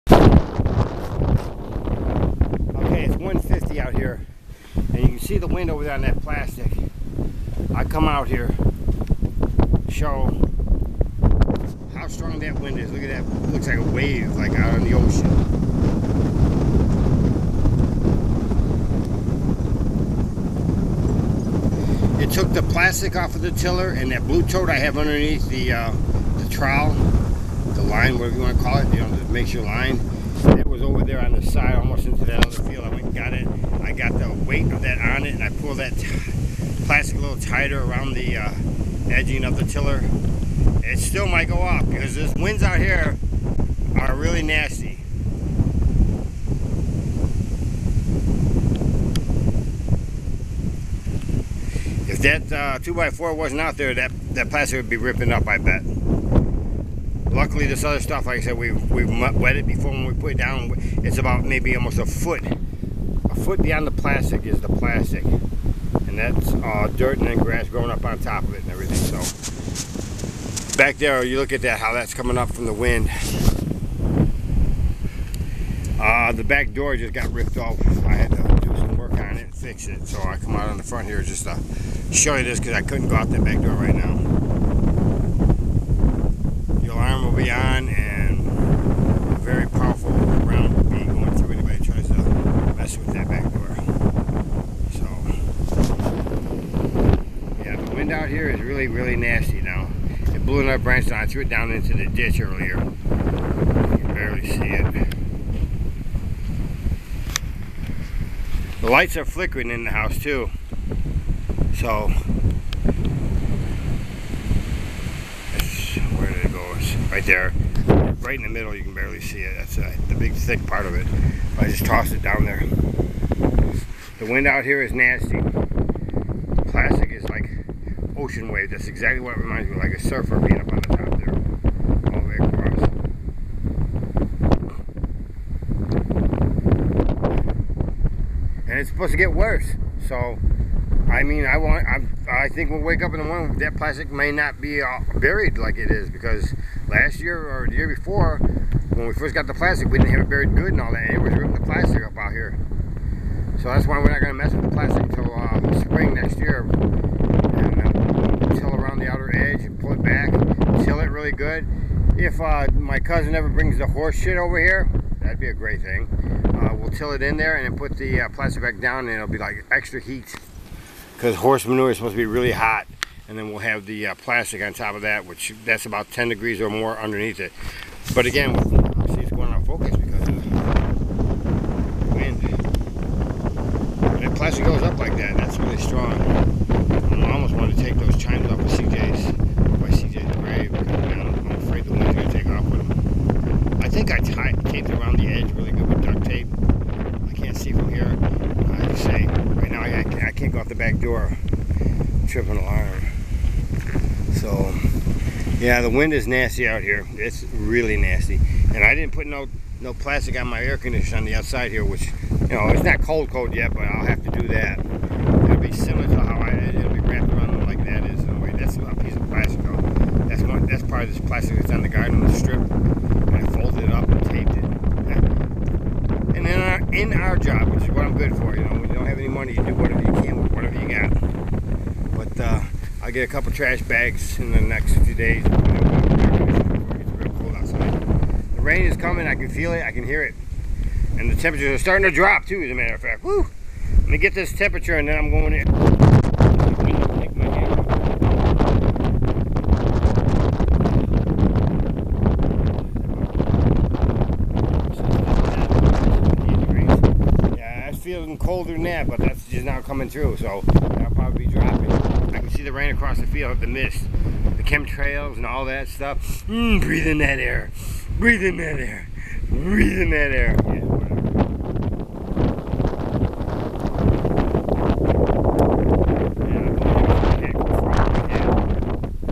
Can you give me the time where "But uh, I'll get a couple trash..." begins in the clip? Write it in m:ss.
3:52.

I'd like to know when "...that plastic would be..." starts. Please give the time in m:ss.
0:54.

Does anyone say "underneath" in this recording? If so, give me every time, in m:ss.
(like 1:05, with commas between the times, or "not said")
0:24, 2:56.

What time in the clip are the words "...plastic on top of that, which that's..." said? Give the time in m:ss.
2:54.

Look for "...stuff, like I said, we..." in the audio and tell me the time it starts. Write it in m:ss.
0:57.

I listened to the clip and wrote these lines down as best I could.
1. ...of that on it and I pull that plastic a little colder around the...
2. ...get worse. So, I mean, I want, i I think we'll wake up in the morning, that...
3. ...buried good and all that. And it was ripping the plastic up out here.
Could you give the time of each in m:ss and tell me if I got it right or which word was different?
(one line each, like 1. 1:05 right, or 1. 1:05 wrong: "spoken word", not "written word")
1. 0:34 wrong: "tighter", not "colder"
2. 2:19 right
3. 2:30 right.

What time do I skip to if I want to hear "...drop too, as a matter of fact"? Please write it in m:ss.
4:02.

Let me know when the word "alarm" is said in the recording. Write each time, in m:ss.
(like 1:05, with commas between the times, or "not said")
1:26, 3:22.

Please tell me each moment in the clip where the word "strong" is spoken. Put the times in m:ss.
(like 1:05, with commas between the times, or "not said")
0:12, 3:05.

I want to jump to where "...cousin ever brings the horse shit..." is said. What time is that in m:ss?
2:42.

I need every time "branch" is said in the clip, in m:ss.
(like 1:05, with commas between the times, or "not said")
1:40.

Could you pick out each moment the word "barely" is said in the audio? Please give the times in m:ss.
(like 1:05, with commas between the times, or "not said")
1:44, 1:58.